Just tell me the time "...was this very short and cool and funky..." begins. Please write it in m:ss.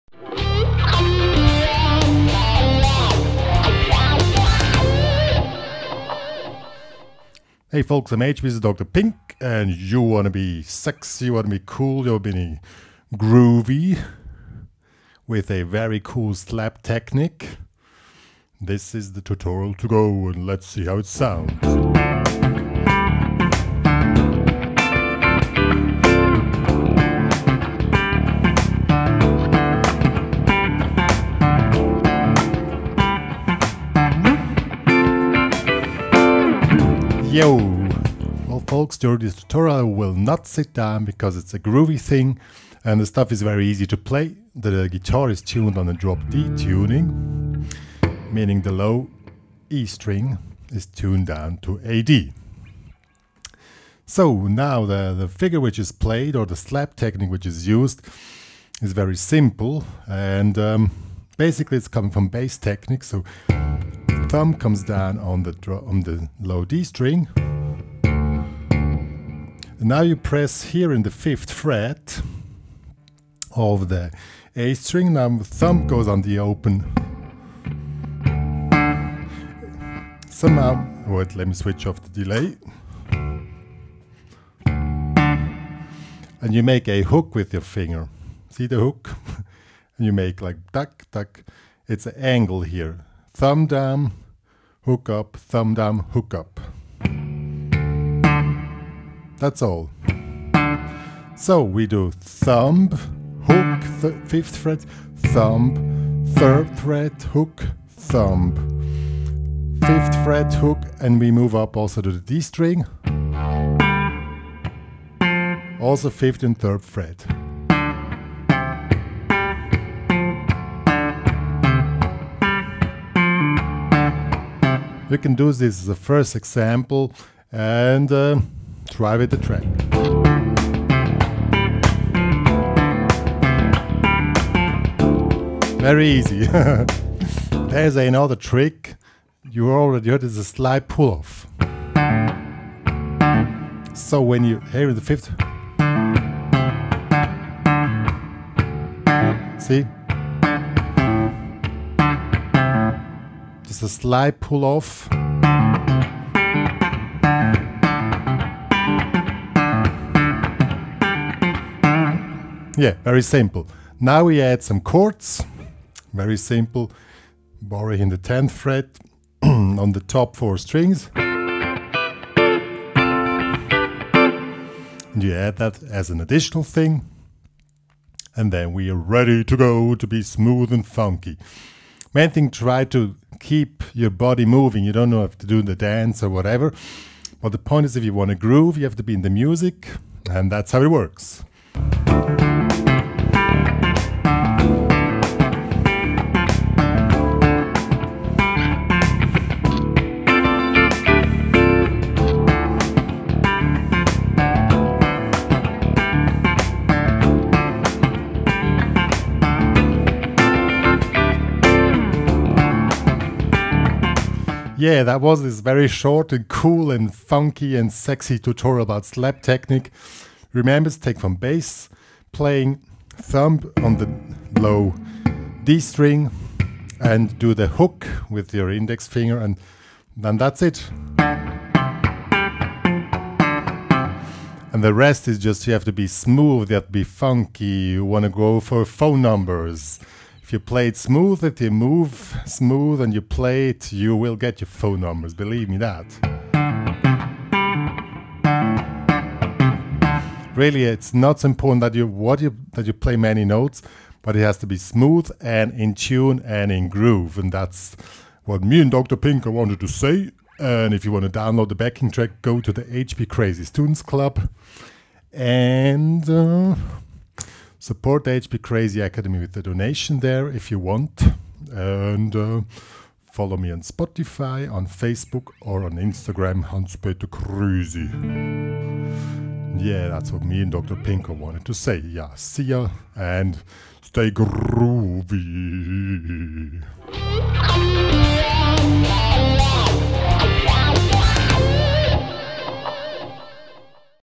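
3:35.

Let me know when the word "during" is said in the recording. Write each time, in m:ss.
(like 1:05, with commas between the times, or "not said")
0:38.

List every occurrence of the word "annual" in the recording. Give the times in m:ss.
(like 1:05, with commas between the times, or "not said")
not said.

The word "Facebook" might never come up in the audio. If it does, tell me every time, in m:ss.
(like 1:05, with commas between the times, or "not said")
4:34.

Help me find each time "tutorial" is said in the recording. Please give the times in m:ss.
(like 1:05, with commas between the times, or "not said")
0:19, 0:39, 3:38.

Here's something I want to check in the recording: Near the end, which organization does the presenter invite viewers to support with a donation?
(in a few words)
HPCrazy Academy.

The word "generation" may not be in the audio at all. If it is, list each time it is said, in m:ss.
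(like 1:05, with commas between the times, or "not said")
not said.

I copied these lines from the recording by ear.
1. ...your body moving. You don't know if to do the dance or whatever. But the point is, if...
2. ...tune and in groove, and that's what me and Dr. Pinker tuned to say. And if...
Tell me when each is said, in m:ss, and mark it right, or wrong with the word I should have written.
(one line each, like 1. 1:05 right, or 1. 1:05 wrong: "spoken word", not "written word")
1. 3:03 right
2. 4:15 wrong: "wanted", not "tuned".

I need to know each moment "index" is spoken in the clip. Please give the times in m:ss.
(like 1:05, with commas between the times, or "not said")
3:48.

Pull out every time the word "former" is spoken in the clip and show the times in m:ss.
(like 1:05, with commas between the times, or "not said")
not said.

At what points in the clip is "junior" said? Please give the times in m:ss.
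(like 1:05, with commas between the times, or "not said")
not said.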